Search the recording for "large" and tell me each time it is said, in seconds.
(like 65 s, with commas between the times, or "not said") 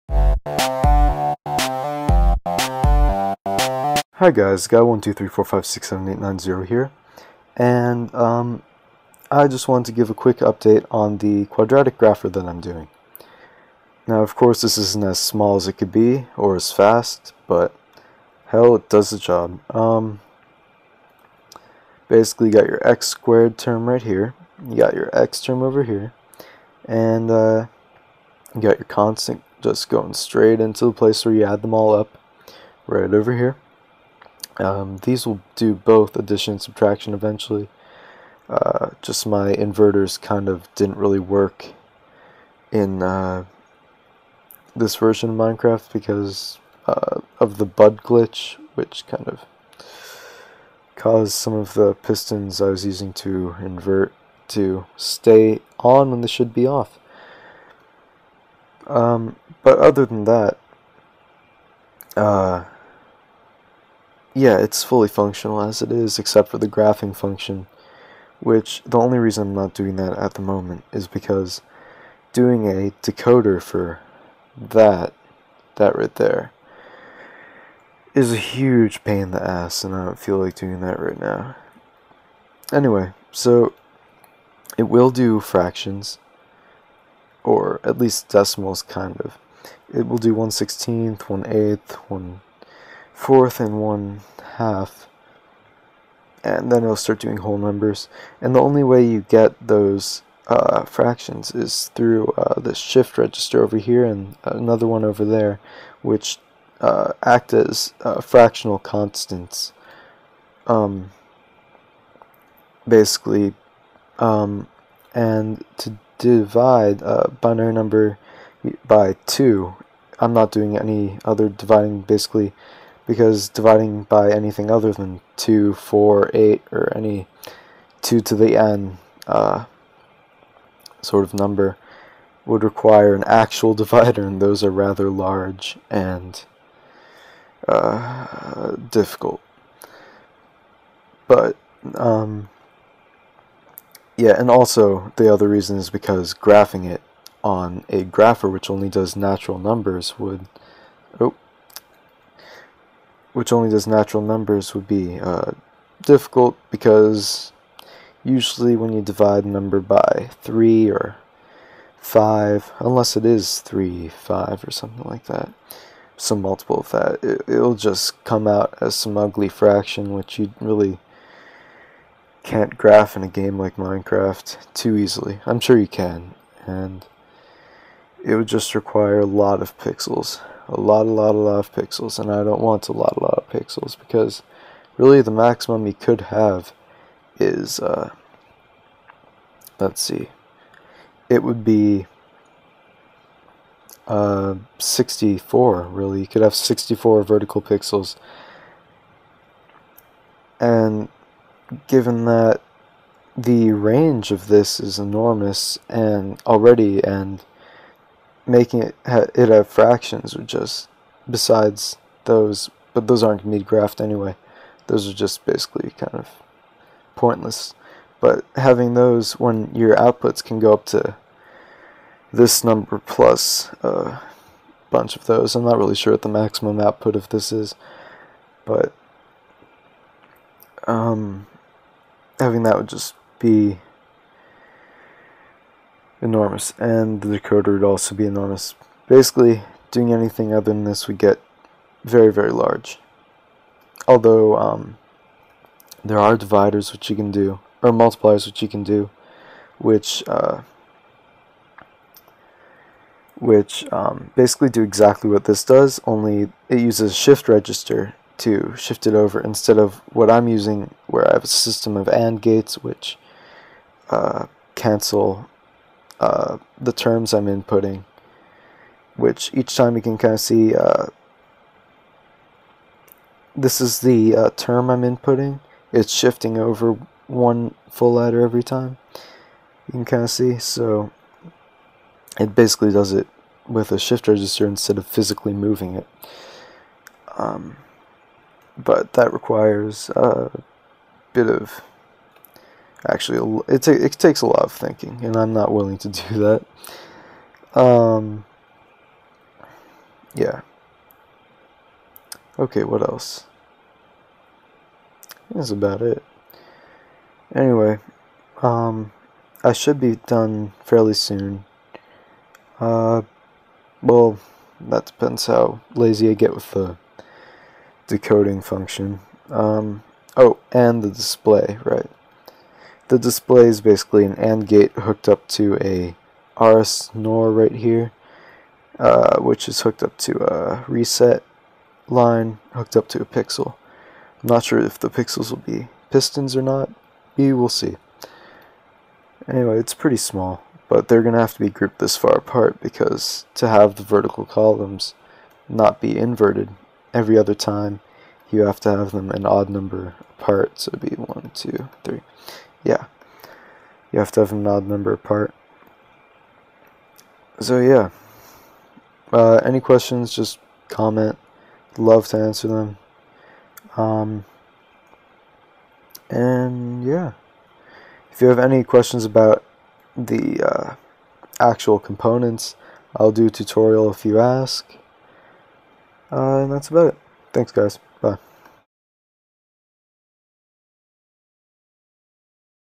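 135 s, 242 s.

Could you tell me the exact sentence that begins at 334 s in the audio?
I'm not sure if the pixels will be pistons or not.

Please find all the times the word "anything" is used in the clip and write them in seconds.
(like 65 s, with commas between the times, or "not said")
124 s, 240 s.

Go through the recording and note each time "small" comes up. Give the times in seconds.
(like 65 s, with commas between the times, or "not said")
15 s, 340 s.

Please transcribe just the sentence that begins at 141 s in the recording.
But, um, yeah, and also the other reason is because graphing it on a grapher which only does natural numbers would.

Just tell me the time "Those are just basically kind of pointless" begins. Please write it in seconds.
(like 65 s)
214 s.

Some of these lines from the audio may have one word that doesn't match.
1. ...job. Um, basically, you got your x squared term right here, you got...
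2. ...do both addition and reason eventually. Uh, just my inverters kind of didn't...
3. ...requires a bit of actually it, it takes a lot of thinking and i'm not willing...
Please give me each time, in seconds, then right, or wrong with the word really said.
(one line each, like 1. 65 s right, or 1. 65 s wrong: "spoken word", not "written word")
1. 19 s right
2. 35 s wrong: "subtraction", not "reason"
3. 289 s right.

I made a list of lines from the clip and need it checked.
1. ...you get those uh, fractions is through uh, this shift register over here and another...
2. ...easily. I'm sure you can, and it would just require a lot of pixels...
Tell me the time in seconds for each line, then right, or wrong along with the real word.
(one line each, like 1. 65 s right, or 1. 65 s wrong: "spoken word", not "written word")
1. 99 s right
2. 174 s right.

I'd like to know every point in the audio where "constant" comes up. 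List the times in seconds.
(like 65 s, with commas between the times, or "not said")
28 s, 108 s.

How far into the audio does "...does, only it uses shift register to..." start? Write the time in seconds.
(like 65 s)
255 s.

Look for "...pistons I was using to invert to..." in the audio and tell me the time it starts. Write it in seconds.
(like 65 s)
51 s.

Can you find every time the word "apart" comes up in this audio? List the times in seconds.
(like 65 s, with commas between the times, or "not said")
342 s, 350 s, 355 s.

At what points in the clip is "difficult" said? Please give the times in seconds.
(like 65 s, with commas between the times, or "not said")
138 s, 156 s.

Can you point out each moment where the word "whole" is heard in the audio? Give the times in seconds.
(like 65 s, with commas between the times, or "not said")
97 s.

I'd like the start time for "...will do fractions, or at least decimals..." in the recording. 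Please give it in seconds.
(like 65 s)
84 s.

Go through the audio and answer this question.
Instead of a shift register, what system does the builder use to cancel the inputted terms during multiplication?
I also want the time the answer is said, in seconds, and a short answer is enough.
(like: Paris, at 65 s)
AND gates, at 262 s.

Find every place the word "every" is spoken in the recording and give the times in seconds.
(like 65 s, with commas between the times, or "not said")
278 s, 347 s.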